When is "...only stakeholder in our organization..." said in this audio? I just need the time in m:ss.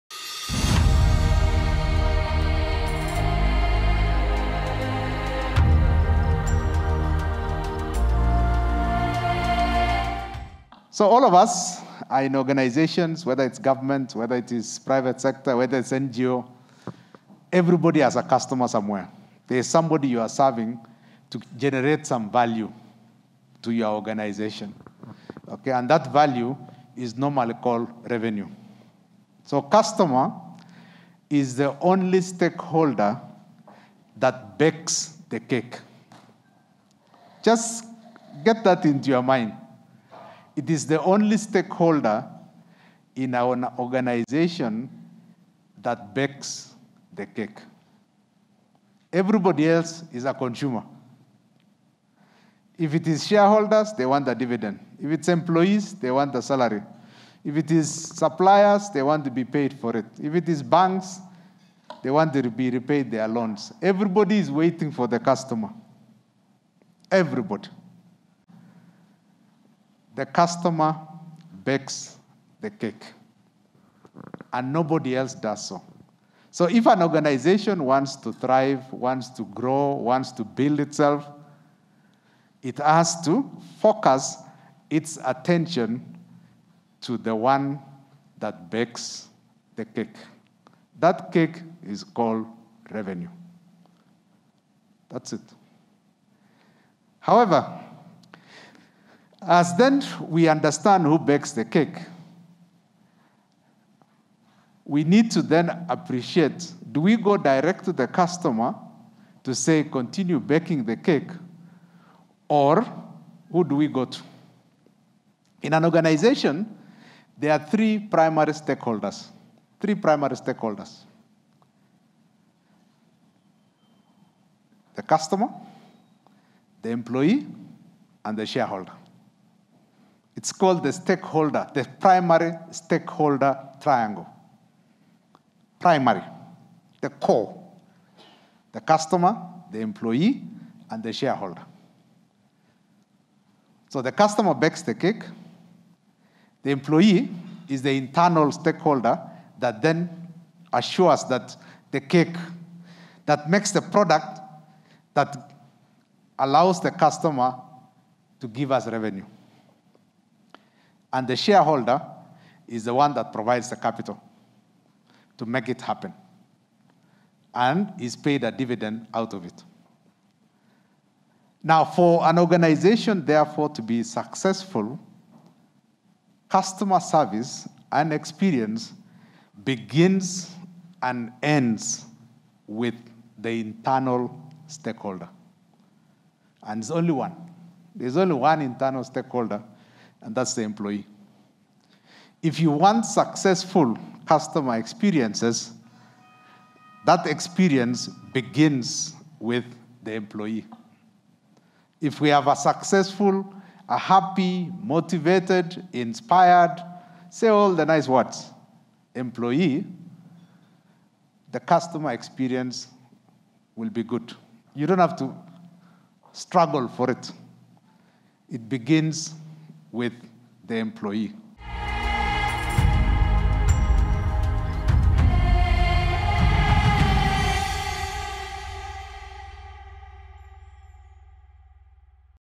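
0:41.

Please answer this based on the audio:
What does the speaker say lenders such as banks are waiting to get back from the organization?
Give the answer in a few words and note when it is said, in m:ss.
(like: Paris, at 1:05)
their loans, at 1:02.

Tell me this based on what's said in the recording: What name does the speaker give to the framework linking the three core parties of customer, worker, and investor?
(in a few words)
primary stakeholder triangle.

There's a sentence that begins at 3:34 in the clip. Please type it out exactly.
You don't have to struggle for it.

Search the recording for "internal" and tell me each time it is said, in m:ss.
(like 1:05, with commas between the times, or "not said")
2:27, 3:03, 3:08.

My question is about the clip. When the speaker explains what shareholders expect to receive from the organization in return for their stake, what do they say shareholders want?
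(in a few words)
the dividend.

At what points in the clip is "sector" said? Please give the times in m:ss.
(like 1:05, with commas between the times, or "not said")
0:15.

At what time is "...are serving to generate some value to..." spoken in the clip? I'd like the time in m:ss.
0:20.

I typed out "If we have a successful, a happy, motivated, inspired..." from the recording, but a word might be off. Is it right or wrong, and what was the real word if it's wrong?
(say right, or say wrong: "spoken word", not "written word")
right.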